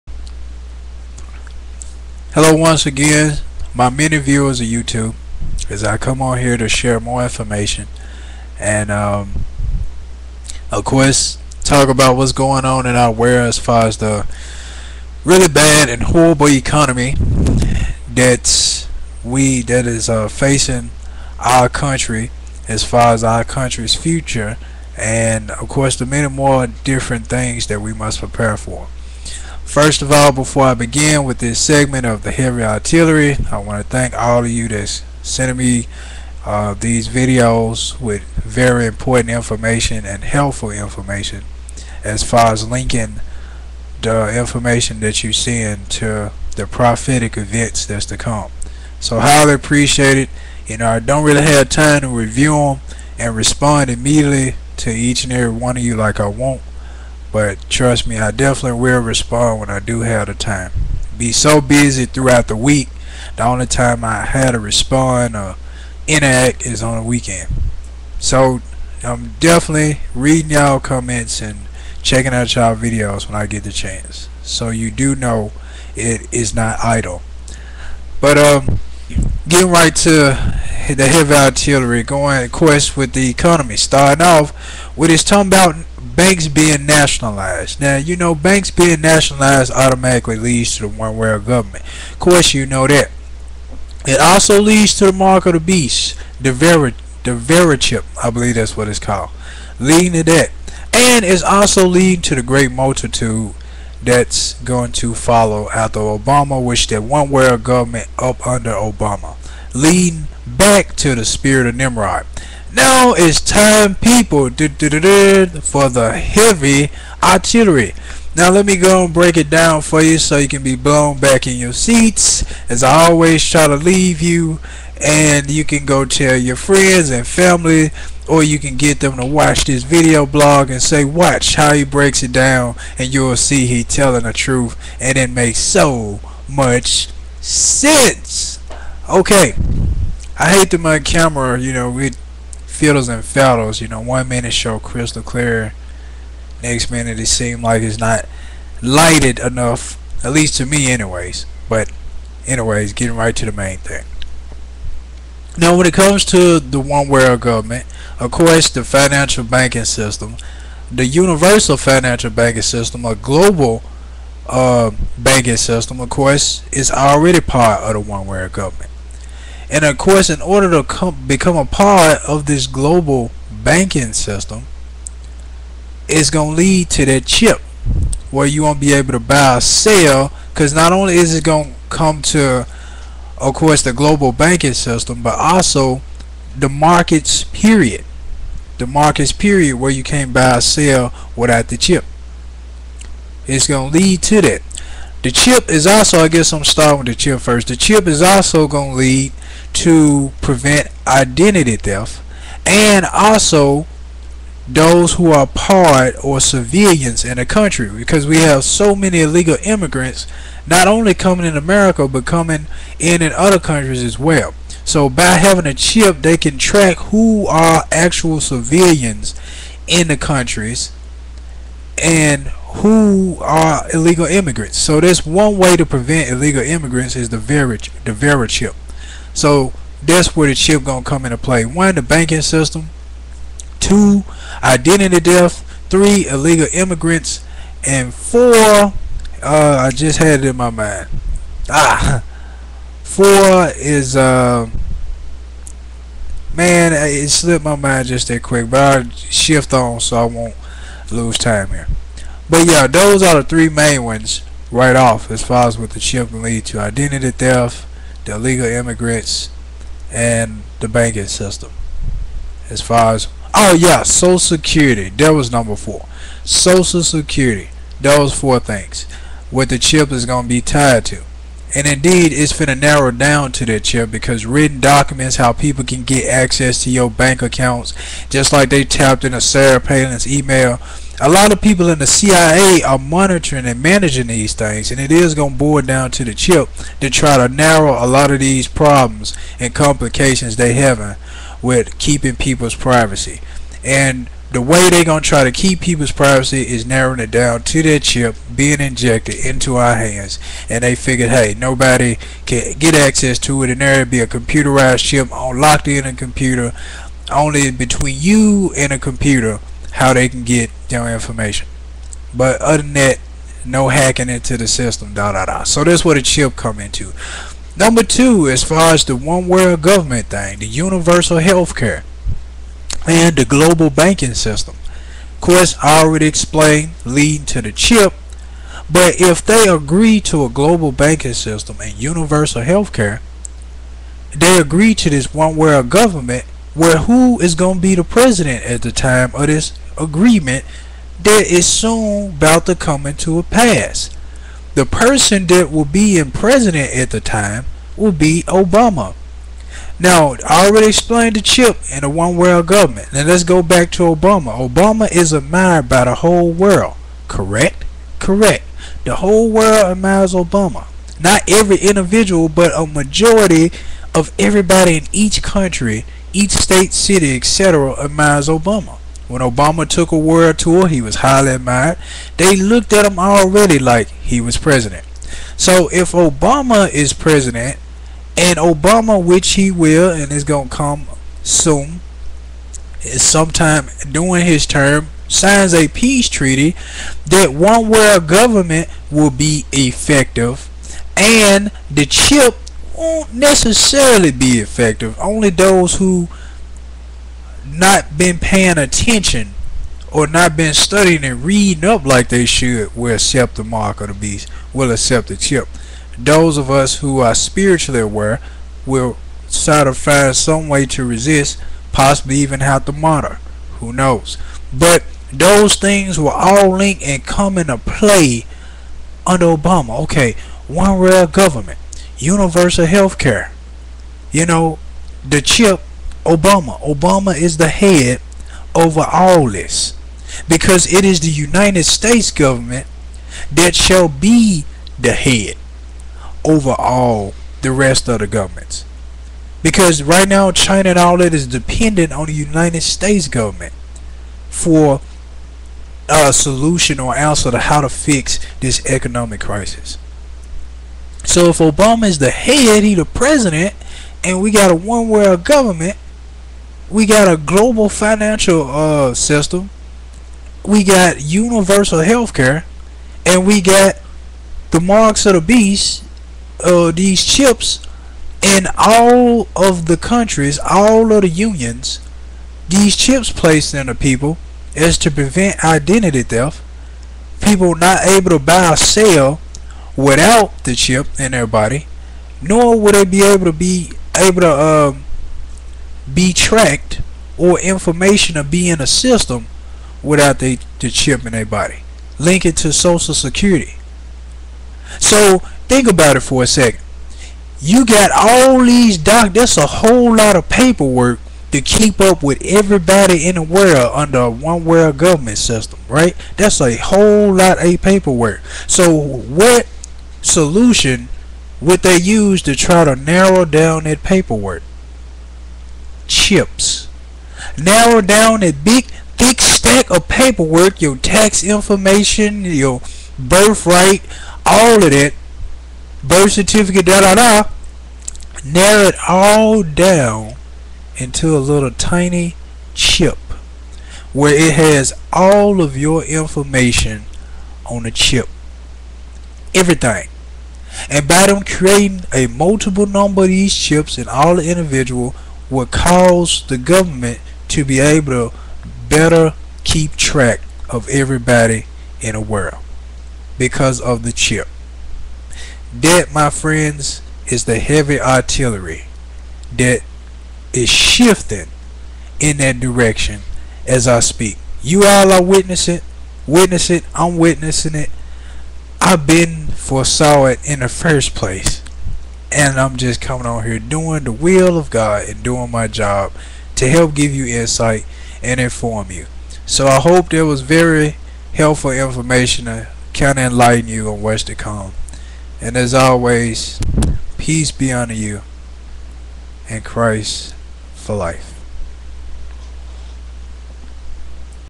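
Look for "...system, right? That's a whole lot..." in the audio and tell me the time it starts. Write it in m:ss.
8:25.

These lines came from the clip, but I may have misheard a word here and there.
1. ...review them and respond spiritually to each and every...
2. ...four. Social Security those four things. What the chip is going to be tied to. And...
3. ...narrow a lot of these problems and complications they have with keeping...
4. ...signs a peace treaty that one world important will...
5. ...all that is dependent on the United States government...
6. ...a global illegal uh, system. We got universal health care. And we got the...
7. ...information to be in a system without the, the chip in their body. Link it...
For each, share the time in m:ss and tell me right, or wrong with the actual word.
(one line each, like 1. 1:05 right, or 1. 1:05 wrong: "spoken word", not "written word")
1. 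0:52 wrong: "immediately", not "spiritually"
2. 4:25 right
3. 4:47 right
4. 6:25 wrong: "government", not "important"
5. 7:20 right
6. 7:37 wrong: "financial", not "illegal"
7. 8:07 right.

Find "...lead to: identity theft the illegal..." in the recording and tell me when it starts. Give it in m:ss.
4:16.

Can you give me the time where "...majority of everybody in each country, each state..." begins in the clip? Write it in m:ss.
6:02.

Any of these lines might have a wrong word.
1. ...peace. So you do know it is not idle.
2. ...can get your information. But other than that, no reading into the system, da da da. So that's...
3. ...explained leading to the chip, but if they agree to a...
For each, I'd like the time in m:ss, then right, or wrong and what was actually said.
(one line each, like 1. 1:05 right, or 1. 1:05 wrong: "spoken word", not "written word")
1. 1:13 wrong: "chance", not "peace"
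2. 5:10 wrong: "hacking", not "reading"
3. 5:26 right.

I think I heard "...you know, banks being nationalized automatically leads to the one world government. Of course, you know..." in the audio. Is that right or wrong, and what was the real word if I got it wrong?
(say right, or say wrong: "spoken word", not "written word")
right.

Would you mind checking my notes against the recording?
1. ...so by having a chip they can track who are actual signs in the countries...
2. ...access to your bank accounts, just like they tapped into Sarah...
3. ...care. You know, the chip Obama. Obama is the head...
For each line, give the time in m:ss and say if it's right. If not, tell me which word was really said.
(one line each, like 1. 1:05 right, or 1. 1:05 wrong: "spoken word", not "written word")
1. 3:34 wrong: "civilians", not "signs"
2. 4:36 right
3. 7:03 right.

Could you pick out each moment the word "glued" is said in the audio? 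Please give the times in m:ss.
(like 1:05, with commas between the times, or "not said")
not said.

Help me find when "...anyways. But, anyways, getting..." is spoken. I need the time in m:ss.
2:30.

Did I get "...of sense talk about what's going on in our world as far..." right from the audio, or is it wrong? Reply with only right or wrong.
wrong.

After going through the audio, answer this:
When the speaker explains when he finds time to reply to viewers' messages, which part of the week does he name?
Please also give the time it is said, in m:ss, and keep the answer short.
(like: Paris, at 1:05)
the weekend, at 1:07.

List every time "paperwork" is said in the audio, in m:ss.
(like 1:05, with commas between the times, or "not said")
8:20, 8:27, 8:34, 8:40.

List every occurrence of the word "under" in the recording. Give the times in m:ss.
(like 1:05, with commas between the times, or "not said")
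1:48, 6:59, 8:23.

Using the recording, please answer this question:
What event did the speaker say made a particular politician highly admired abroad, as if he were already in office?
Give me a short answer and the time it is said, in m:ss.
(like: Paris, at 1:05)
a world tour, at 6:10.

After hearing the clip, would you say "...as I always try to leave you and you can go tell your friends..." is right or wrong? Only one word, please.
right.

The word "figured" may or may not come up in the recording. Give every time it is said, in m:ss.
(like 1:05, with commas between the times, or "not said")
5:00.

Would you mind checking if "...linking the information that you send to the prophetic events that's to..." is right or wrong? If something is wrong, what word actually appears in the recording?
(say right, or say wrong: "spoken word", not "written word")
right.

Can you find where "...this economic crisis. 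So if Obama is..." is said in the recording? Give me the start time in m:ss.
7:28.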